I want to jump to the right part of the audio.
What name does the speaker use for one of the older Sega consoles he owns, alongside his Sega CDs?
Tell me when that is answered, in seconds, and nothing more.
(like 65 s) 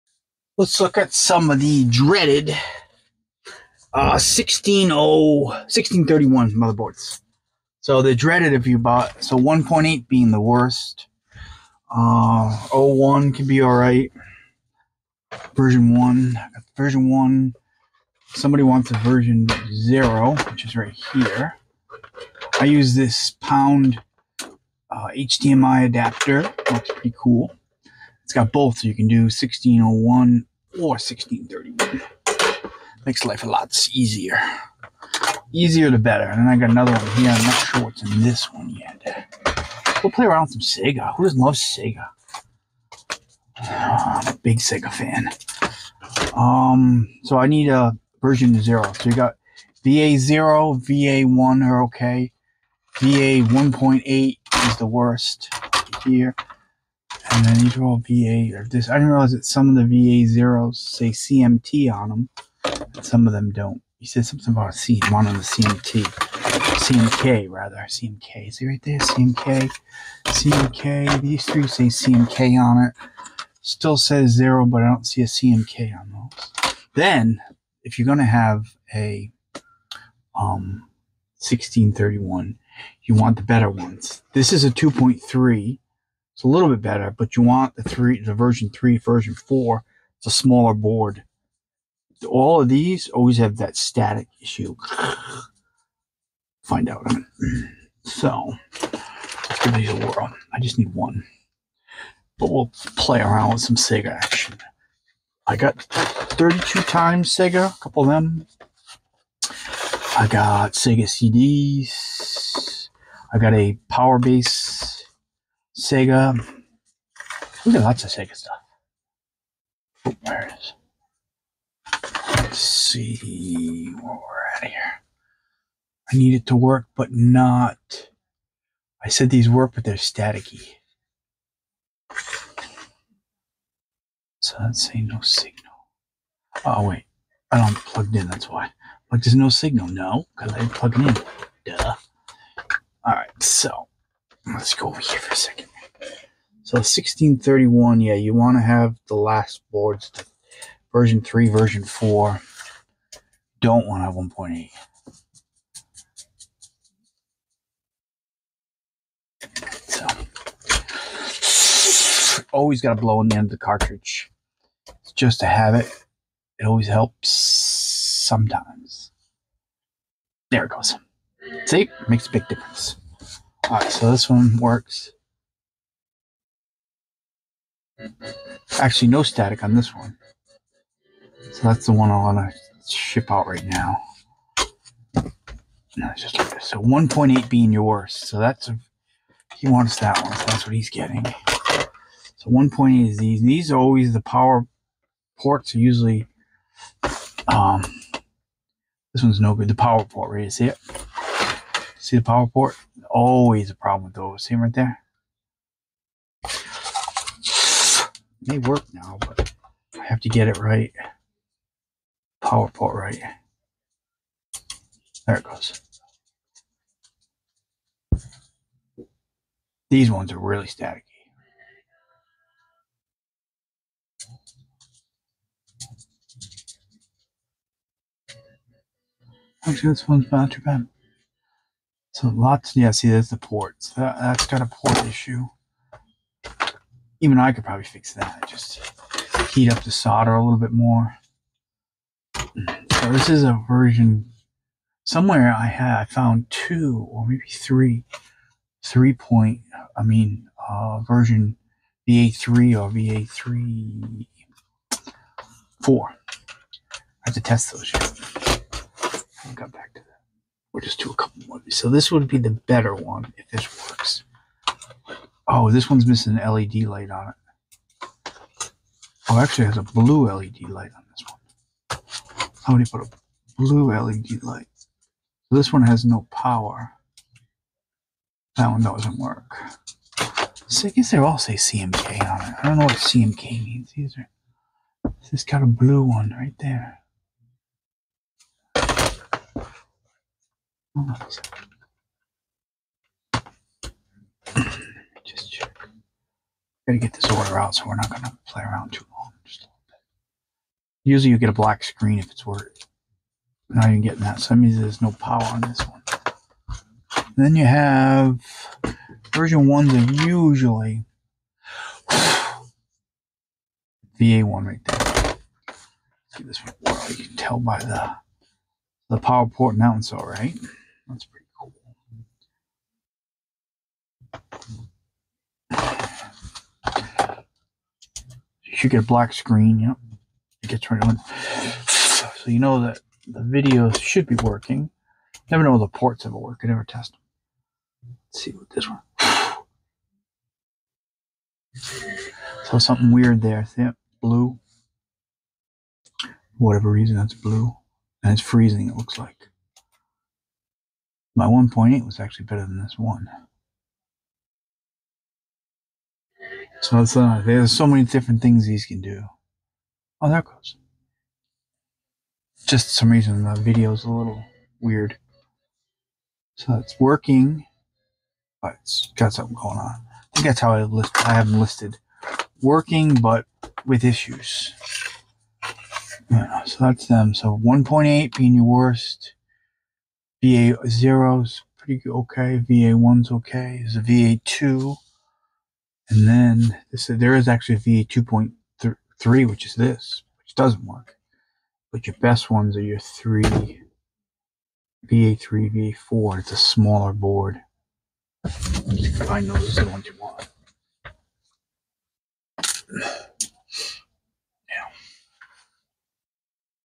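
113 s.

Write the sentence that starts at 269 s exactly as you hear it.
Oh, actually, it has a blue LED light on this one.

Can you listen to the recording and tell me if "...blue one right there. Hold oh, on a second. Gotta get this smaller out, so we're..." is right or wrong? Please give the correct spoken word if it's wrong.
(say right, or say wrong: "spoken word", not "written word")
wrong: "order", not "smaller".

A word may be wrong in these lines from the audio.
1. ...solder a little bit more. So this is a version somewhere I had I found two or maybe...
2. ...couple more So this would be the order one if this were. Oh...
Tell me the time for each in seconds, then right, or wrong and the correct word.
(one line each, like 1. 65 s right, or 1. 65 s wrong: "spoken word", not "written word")
1. 239 s right
2. 261 s wrong: "better", not "order".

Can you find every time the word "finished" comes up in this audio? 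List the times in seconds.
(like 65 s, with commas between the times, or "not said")
not said.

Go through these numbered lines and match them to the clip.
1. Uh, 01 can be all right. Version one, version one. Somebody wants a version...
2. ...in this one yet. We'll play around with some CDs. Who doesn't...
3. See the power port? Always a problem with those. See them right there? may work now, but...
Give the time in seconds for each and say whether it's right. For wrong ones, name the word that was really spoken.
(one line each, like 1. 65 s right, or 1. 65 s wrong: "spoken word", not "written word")
1. 11 s right
2. 38 s wrong: "Sega", not "CDs"
3. 201 s right.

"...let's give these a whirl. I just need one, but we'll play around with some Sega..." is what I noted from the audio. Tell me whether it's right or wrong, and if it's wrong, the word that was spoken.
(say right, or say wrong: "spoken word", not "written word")
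right.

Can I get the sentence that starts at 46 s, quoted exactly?
Um, so I need a version zero.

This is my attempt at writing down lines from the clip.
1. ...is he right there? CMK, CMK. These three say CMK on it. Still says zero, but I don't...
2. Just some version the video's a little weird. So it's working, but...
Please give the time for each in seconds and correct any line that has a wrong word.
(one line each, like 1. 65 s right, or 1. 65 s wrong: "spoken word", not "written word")
1. 68 s right
2. 362 s wrong: "reason", not "version".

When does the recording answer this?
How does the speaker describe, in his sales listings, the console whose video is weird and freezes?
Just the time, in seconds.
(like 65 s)
372 s.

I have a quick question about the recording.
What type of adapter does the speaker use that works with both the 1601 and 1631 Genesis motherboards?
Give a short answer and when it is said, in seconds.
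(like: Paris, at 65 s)
HDMI adapter, at 25 s.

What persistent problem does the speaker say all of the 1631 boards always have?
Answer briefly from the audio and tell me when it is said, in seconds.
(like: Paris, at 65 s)
static issue, at 93 s.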